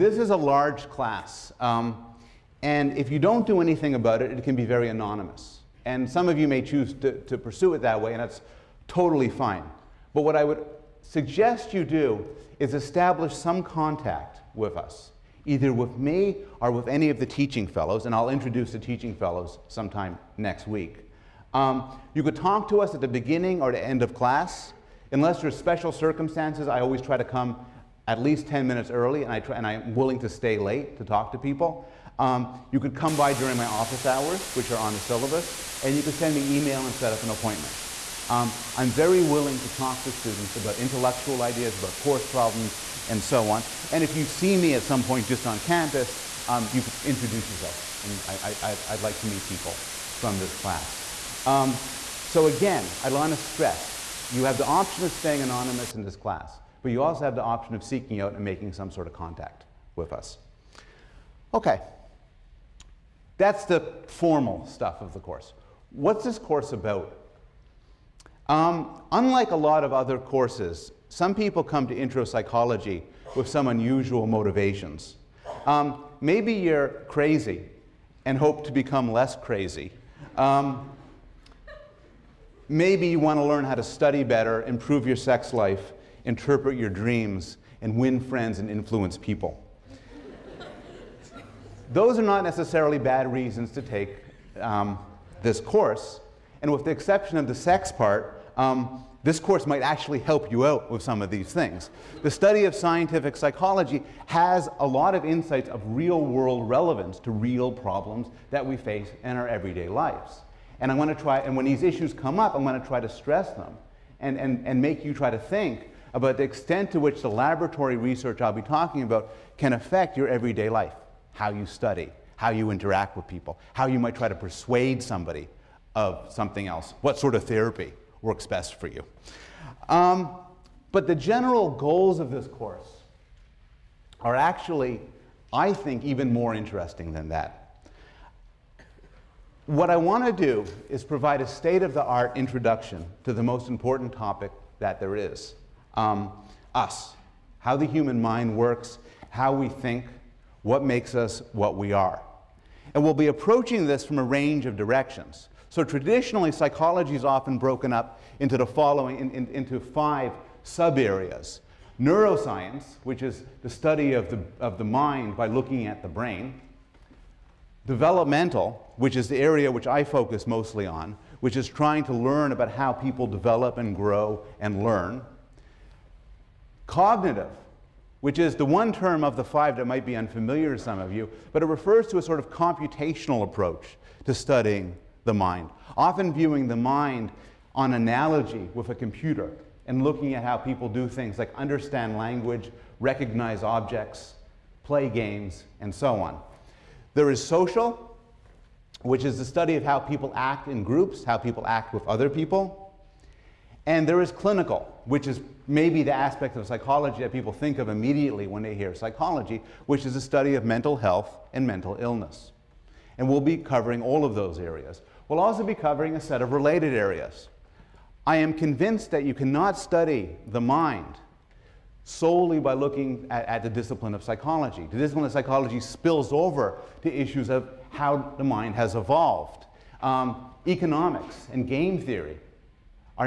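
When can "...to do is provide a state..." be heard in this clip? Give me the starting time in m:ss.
2:20.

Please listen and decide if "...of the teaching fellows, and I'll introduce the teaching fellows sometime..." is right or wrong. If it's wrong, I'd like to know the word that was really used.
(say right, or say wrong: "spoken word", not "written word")
right.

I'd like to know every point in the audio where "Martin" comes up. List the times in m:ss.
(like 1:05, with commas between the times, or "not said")
not said.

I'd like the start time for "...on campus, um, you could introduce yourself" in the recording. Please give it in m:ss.
0:45.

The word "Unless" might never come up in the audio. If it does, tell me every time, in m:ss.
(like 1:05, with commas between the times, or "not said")
0:25.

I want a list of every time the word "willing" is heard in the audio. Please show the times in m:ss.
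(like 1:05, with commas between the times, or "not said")
0:29, 0:39.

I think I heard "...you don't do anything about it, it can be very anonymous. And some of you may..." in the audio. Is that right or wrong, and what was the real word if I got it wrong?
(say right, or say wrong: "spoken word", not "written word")
right.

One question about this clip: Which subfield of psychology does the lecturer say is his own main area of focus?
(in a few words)
Developmental.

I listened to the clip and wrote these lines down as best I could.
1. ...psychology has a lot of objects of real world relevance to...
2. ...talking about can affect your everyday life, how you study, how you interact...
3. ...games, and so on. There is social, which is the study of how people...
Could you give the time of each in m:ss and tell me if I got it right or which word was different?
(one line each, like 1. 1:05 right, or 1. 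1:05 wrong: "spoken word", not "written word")
1. 1:43 wrong: "insights", not "objects"
2. 1:58 right
3. 3:15 right.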